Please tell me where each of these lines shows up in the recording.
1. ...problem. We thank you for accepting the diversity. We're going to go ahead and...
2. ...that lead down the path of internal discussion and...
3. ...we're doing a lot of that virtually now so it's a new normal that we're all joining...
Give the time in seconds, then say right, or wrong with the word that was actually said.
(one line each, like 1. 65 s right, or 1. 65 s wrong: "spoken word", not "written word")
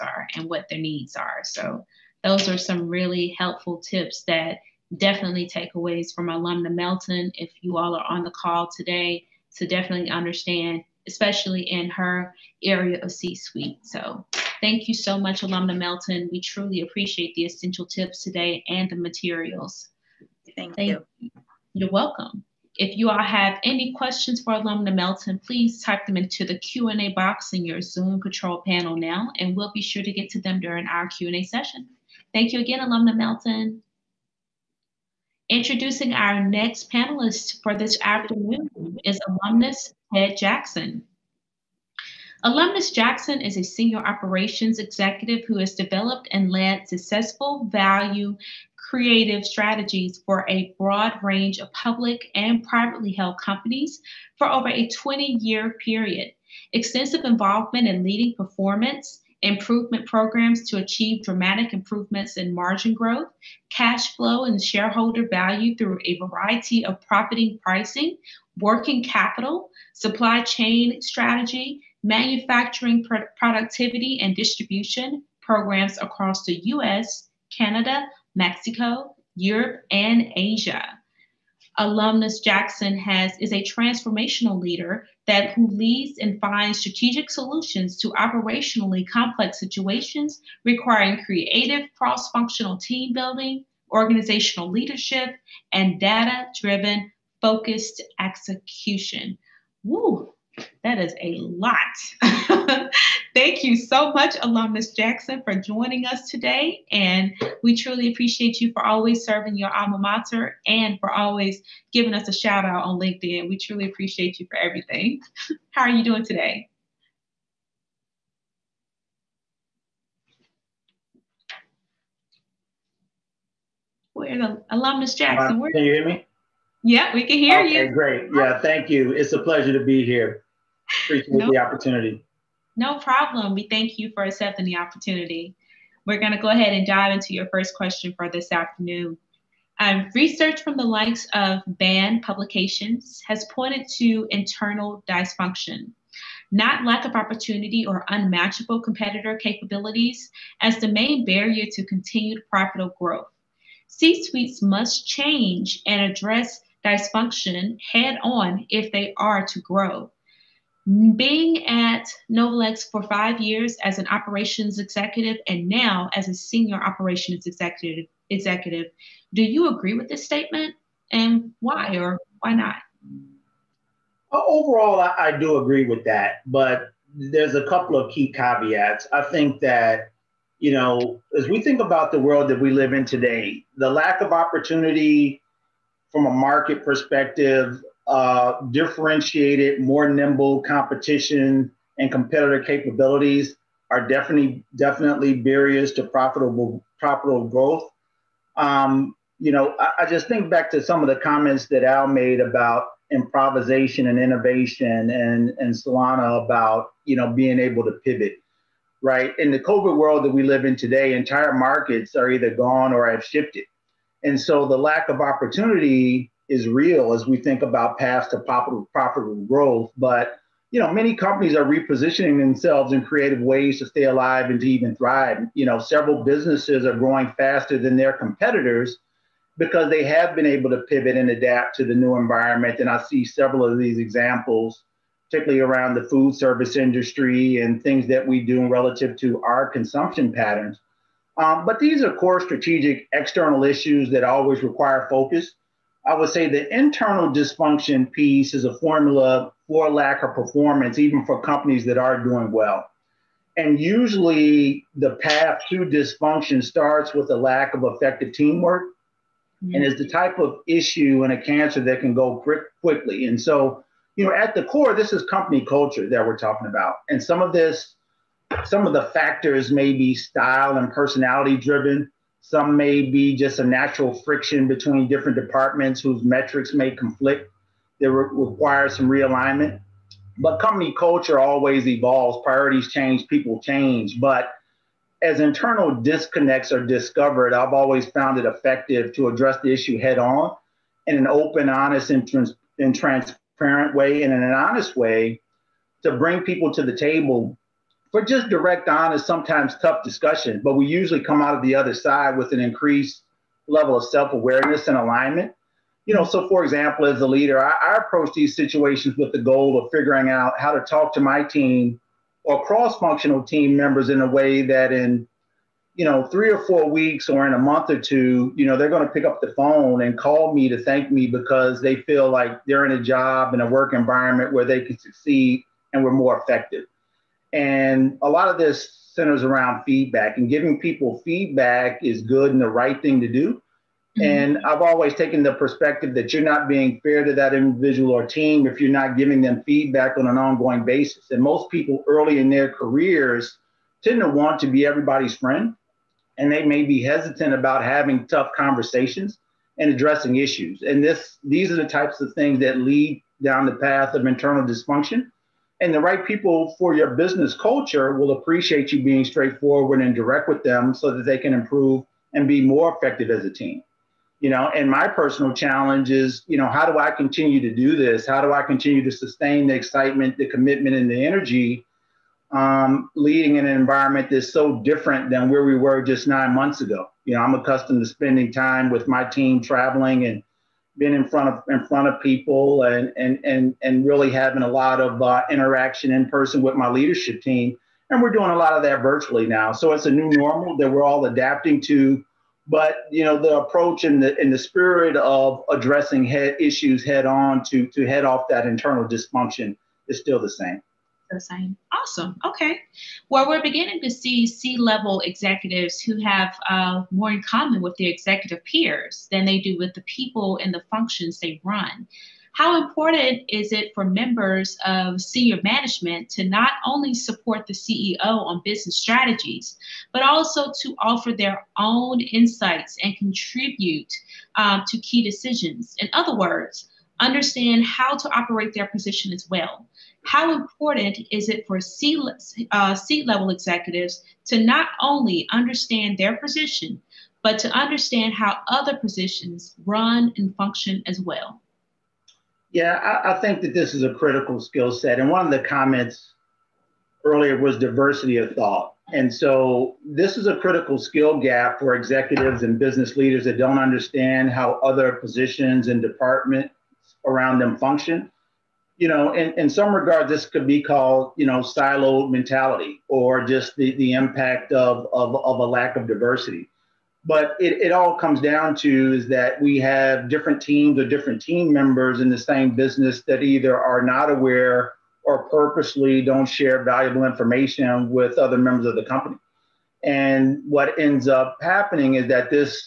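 1. 132 s wrong: "opportunity", not "diversity"
2. 352 s wrong: "dysfunction", not "discussion"
3. 388 s wrong: "adapting", not "joining".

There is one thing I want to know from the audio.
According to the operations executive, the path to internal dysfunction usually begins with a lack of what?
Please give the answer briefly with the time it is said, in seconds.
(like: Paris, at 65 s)
Effective teamwork, at 257 s.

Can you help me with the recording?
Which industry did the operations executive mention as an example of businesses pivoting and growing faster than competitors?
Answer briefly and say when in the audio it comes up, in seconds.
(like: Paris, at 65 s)
Food service, at 236 s.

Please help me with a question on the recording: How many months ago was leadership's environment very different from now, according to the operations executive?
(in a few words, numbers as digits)
9.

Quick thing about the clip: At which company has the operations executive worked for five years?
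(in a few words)
Novolex.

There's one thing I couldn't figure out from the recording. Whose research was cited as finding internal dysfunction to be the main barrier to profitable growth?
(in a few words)
Bain.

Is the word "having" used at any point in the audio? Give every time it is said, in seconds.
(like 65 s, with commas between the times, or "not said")
347 s, 384 s.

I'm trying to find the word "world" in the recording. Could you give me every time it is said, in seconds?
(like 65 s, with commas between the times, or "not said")
182 s, 209 s.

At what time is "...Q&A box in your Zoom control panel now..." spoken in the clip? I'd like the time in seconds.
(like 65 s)
26 s.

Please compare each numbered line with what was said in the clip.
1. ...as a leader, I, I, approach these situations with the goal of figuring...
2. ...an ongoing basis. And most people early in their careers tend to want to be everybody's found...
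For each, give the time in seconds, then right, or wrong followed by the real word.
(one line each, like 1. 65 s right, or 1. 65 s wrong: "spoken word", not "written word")
1. 307 s right
2. 340 s wrong: "friend", not "found".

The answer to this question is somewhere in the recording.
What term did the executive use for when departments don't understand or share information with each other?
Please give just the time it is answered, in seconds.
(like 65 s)
461 s.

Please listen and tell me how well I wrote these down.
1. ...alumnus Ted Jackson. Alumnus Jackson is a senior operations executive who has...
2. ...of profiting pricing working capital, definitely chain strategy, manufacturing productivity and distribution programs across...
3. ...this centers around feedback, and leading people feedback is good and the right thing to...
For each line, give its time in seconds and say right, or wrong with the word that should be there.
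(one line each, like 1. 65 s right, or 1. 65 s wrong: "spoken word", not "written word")
1. 39 s right
2. 66 s wrong: "supply", not "definitely"
3. 328 s wrong: "giving", not "leading".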